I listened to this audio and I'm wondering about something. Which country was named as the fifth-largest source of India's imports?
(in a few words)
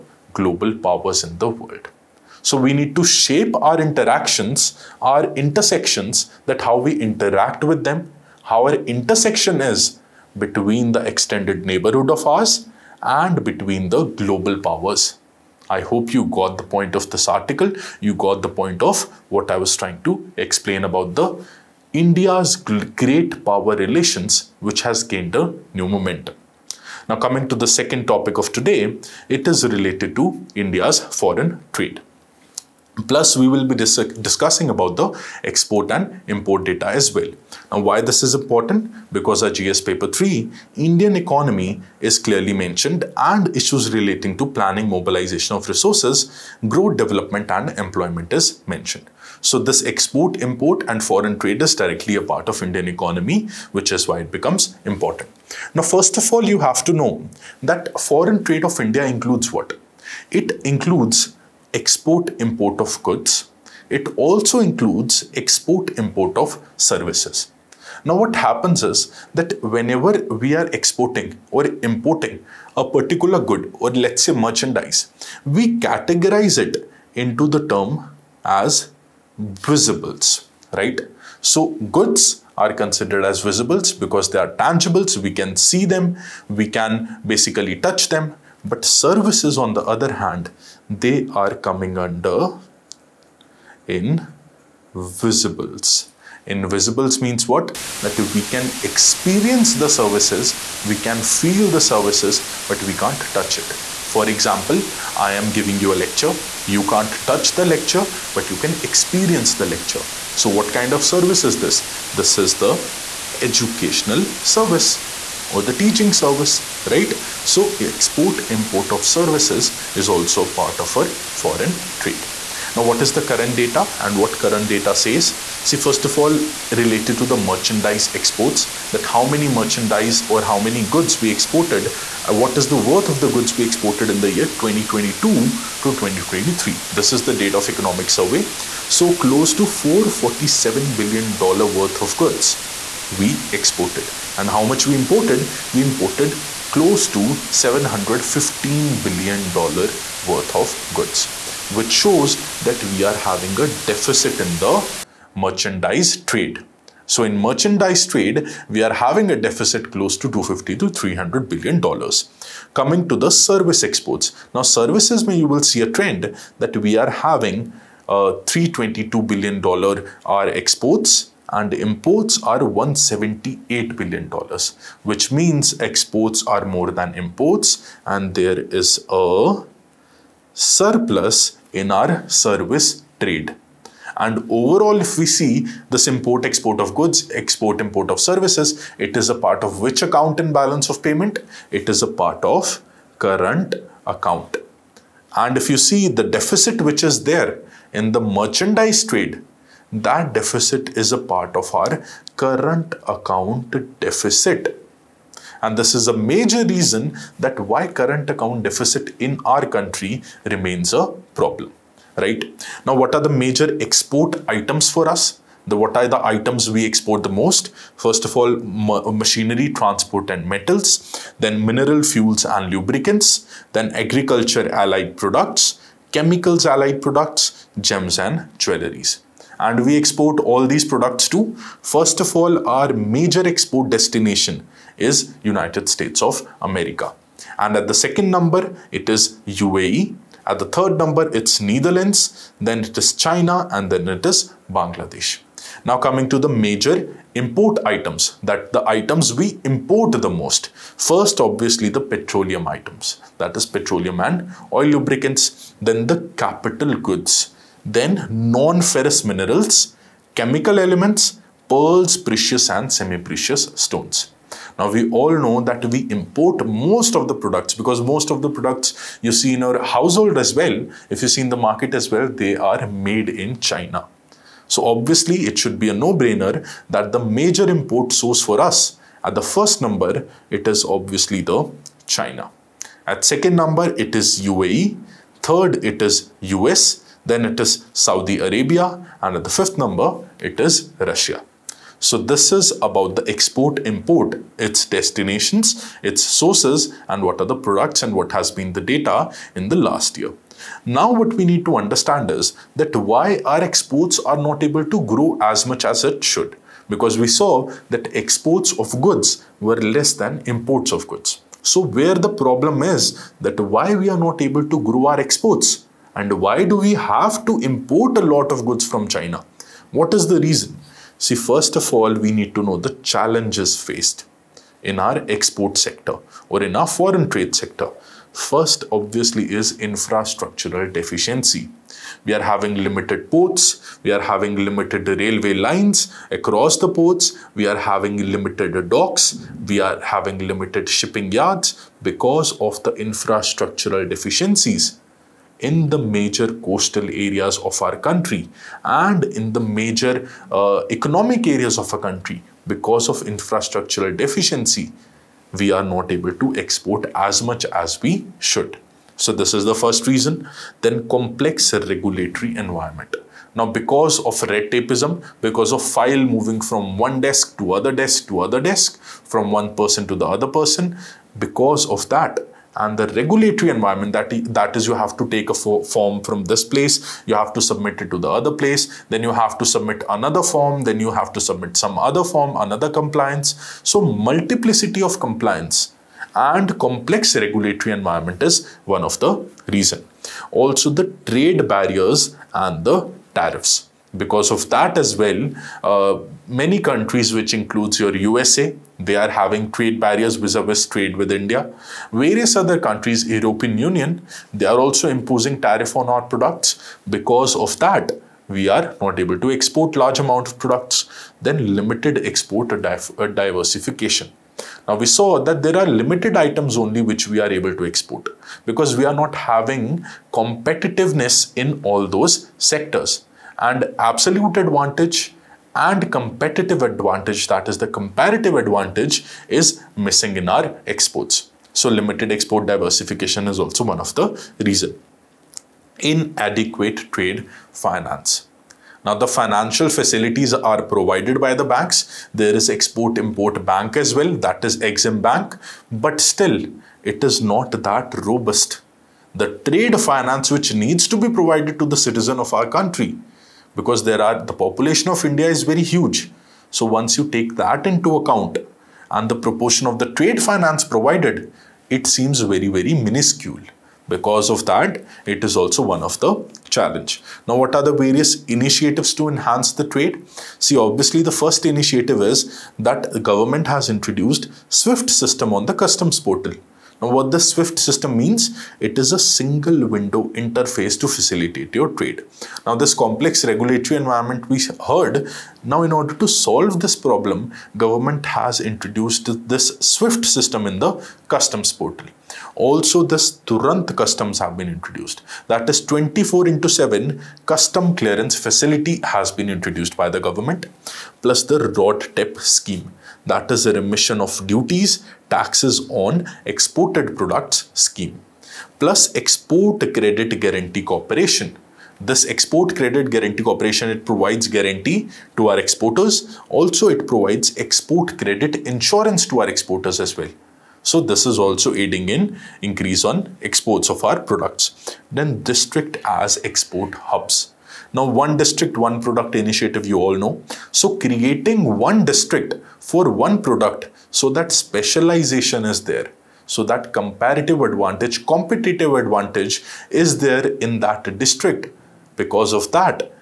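Russia.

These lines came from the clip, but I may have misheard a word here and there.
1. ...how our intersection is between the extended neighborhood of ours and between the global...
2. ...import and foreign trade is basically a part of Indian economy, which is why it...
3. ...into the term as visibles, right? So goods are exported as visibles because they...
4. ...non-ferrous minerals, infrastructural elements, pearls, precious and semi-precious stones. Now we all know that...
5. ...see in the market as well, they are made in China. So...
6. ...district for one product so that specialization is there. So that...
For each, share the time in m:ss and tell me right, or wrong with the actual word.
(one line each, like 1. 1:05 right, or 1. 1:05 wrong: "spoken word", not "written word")
1. 0:08 right
2. 0:50 wrong: "directly", not "basically"
3. 1:17 wrong: "considered", not "exported"
4. 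4:18 wrong: "chemical", not "infrastructural"
5. 4:31 right
6. 8:52 right.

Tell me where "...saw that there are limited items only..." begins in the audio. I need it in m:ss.
6:55.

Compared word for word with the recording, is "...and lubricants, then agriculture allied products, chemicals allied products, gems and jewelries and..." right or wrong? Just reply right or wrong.
right.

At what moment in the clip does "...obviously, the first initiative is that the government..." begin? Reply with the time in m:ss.
7:50.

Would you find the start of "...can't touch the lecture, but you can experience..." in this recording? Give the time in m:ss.
1:46.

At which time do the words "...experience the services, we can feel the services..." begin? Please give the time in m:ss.
1:38.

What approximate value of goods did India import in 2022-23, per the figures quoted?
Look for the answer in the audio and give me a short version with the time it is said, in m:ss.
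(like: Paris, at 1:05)
$715 billion, at 2:27.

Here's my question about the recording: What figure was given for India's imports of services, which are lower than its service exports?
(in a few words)
178 billion dollars.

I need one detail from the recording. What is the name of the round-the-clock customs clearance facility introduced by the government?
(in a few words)
Turant customs.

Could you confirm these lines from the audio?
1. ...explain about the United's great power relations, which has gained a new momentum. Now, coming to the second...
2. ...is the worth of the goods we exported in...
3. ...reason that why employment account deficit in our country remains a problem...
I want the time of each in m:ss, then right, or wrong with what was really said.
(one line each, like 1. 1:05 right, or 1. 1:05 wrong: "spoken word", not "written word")
1. 0:20 wrong: "India", not "United"
2. 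2:12 right
3. 3:26 wrong: "current", not "employment".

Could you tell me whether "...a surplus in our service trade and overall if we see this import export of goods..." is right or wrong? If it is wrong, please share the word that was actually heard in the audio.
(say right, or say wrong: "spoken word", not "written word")
right.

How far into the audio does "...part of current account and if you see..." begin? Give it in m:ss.
3:12.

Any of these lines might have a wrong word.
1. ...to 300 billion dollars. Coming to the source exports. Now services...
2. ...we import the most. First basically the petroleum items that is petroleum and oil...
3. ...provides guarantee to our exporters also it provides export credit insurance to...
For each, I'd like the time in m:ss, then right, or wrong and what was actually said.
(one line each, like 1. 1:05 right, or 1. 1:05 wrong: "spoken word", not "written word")
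1. 2:40 wrong: "service", not "source"
2. 4:09 wrong: "obviously", not "basically"
3. 8:34 right.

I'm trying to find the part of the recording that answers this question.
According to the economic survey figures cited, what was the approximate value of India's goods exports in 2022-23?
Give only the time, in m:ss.
2:19.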